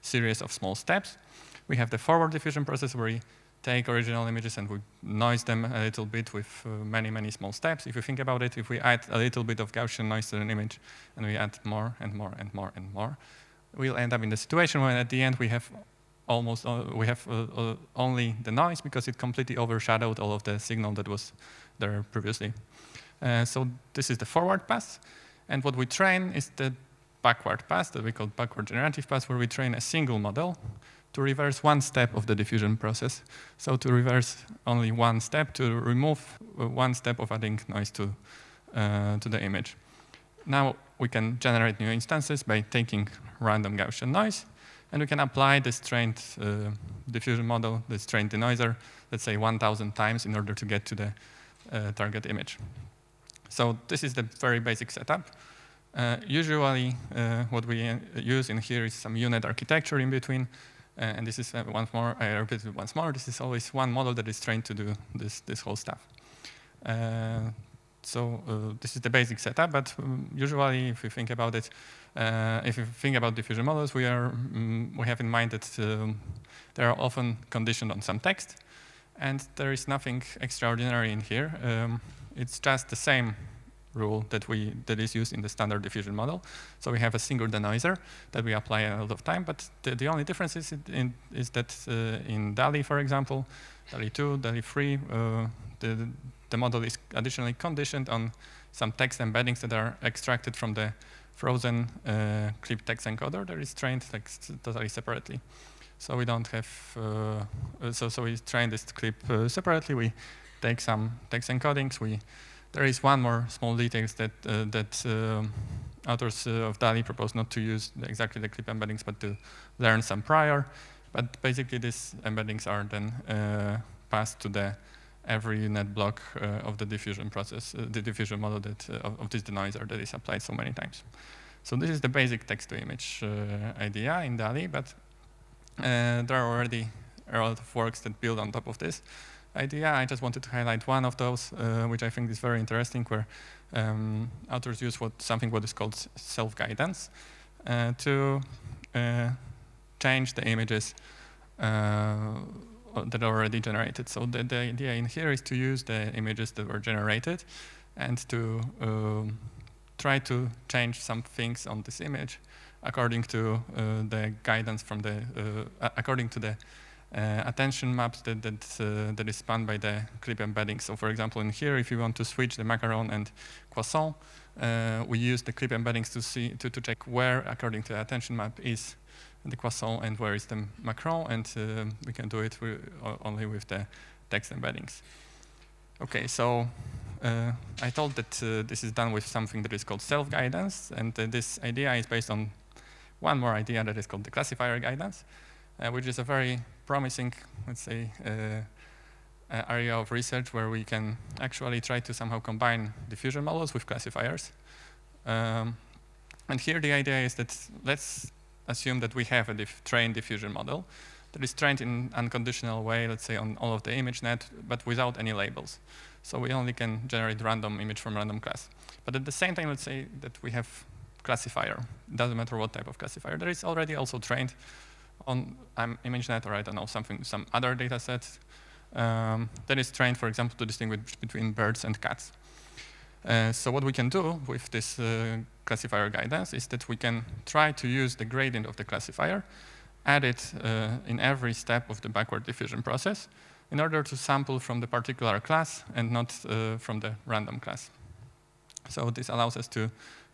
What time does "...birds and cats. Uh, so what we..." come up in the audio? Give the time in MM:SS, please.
03:51.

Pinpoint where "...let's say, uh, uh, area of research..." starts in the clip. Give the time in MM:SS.
03:17.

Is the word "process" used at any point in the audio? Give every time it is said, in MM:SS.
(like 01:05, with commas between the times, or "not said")
00:02, 00:32, 02:07, 04:02.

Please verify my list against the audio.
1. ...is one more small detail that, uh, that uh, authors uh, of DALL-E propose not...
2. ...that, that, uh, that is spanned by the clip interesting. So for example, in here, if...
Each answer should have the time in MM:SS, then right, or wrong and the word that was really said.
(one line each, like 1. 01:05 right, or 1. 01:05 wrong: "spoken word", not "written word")
1. 01:52 right
2. 02:48 wrong: "embedding", not "interesting".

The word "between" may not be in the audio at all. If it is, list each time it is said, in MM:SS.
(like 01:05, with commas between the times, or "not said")
01:00, 03:51.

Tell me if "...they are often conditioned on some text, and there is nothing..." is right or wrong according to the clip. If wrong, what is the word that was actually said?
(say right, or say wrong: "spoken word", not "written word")
right.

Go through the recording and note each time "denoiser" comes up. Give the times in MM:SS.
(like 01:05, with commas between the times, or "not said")
00:48, 01:27, 02:09.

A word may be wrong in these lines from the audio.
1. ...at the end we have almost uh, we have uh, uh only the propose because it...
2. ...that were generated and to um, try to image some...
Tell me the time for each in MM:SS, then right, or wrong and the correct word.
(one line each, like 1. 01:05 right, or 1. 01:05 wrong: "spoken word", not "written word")
1. 00:14 wrong: "noise", not "propose"
2. 02:36 wrong: "change", not "image".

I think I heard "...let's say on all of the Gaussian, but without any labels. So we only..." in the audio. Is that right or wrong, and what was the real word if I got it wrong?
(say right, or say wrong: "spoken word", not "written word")
wrong: "ImageNet", not "Gaussian".